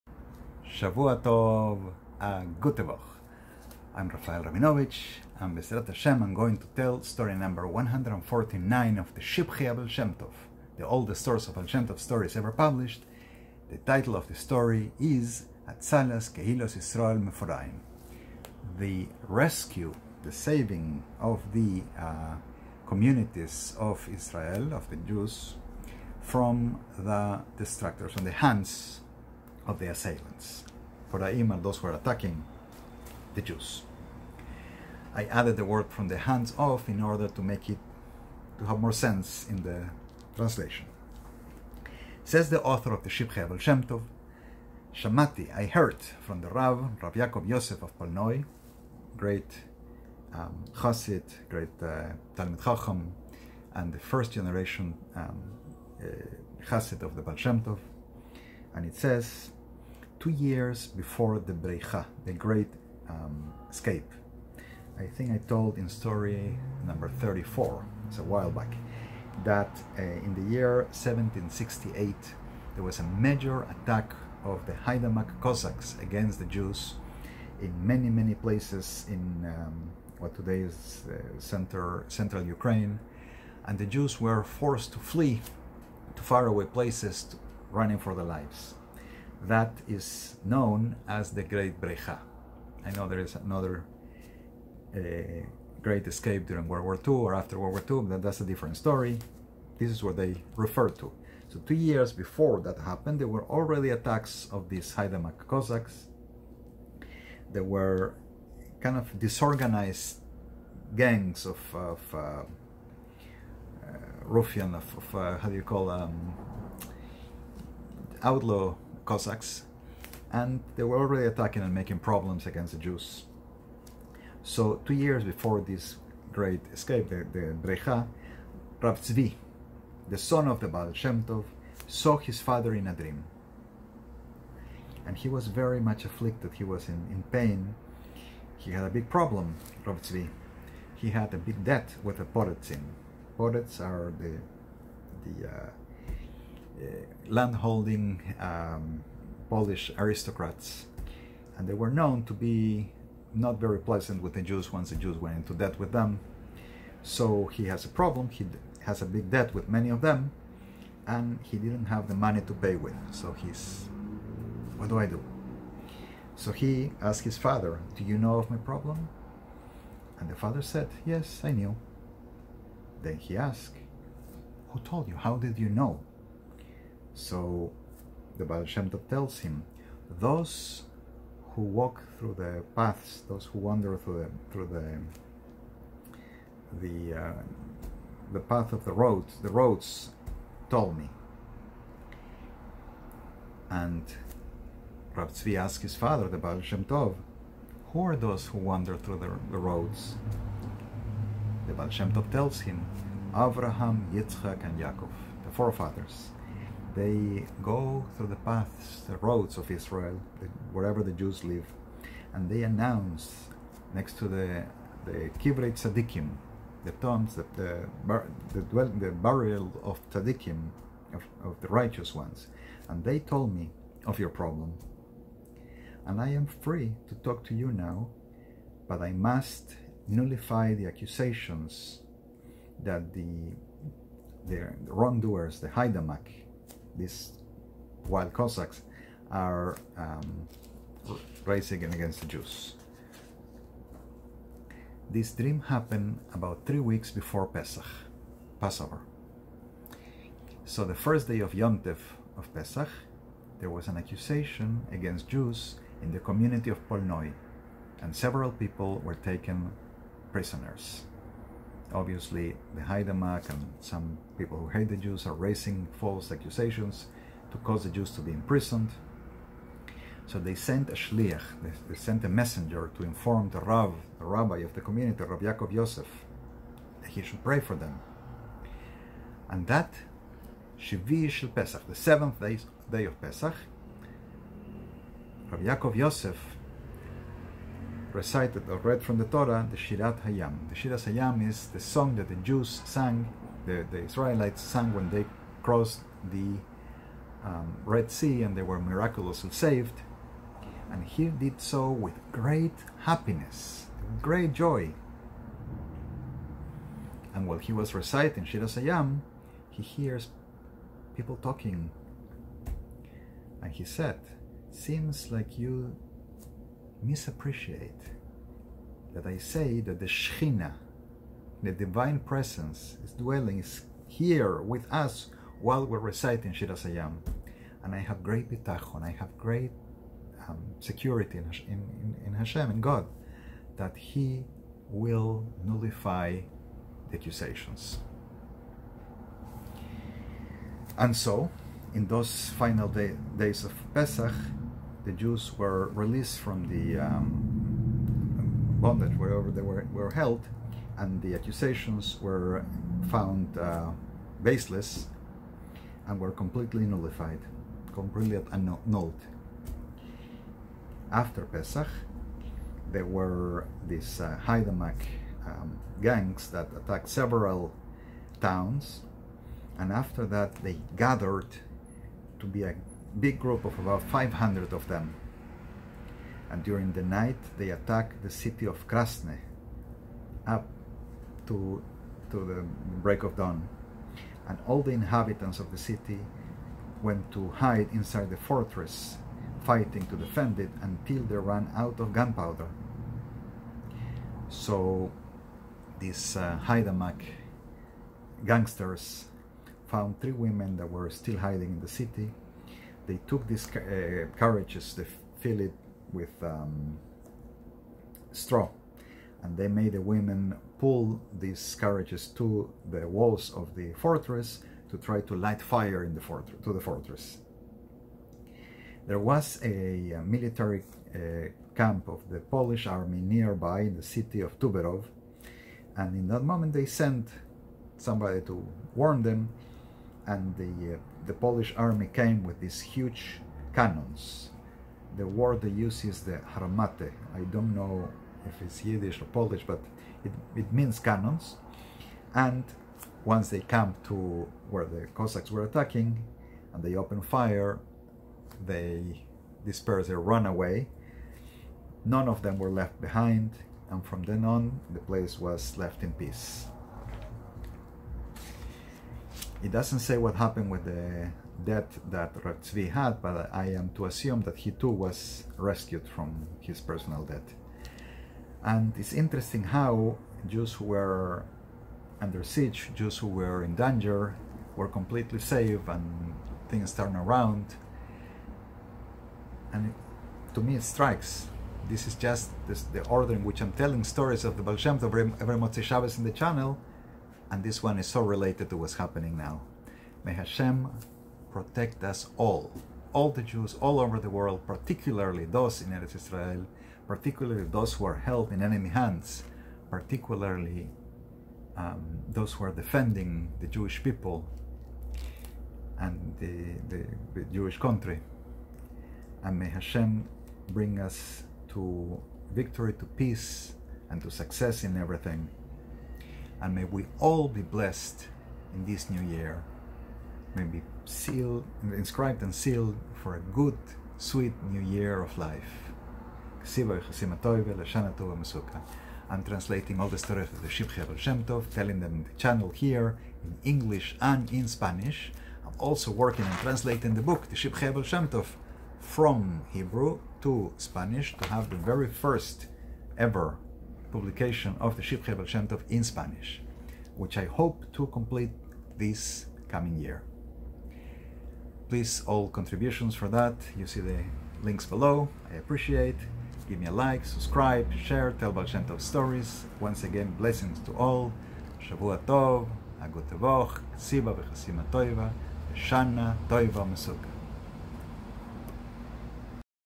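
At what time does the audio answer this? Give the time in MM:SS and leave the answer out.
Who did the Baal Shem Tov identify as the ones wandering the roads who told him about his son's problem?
03:23.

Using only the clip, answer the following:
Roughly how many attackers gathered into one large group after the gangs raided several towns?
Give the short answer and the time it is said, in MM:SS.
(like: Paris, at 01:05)
500, at 06:14.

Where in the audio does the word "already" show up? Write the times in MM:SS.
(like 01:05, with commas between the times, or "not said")
01:43, 02:00.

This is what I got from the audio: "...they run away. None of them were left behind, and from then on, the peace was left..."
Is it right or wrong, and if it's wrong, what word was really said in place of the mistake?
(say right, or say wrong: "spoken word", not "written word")
wrong: "place", not "peace".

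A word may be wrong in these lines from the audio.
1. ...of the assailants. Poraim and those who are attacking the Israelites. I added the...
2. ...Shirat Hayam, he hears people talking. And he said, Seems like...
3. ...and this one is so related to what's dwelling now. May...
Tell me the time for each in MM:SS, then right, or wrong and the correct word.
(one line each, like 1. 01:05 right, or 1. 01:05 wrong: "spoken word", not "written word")
1. 00:29 wrong: "Jews", not "Israelites"
2. 05:08 right
3. 08:07 wrong: "happening", not "dwelling".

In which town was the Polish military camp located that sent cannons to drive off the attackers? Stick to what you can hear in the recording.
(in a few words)
Tuberov.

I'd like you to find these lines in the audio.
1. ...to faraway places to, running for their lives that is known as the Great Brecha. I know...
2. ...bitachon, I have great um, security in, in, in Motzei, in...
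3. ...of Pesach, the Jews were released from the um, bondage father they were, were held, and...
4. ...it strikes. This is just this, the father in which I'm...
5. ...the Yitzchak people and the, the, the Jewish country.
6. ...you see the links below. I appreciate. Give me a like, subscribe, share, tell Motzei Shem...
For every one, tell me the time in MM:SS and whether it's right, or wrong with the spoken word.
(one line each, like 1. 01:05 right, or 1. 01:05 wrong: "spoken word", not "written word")
1. 01:26 right
2. 05:28 wrong: "Hashem", not "Motzei"
3. 05:43 wrong: "wherever", not "father"
4. 08:00 wrong: "order", not "father"
5. 08:23 wrong: "Jewish", not "Yitzchak"
6. 09:13 wrong: "Baal", not "Motzei".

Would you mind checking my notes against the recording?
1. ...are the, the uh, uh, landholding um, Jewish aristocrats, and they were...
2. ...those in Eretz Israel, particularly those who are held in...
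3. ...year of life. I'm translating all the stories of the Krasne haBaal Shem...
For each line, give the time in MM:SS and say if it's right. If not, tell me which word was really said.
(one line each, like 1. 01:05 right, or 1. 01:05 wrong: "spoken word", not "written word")
1. 02:23 wrong: "Polish", not "Jewish"
2. 08:15 right
3. 08:44 wrong: "Shivchei", not "Krasne".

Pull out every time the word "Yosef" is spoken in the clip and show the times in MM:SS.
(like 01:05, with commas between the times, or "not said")
00:47, 04:35, 04:45.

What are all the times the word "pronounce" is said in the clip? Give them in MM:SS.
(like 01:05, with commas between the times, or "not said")
not said.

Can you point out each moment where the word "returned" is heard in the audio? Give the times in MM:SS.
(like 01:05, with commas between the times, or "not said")
not said.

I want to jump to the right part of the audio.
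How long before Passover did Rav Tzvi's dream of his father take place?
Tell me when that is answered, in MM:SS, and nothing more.
04:06.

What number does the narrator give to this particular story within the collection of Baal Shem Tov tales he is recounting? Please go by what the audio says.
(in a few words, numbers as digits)
149.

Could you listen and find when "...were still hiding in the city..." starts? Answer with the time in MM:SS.
06:40.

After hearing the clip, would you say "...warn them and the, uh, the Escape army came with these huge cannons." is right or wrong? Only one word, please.
wrong.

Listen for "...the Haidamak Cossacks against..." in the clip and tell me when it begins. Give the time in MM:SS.
01:14.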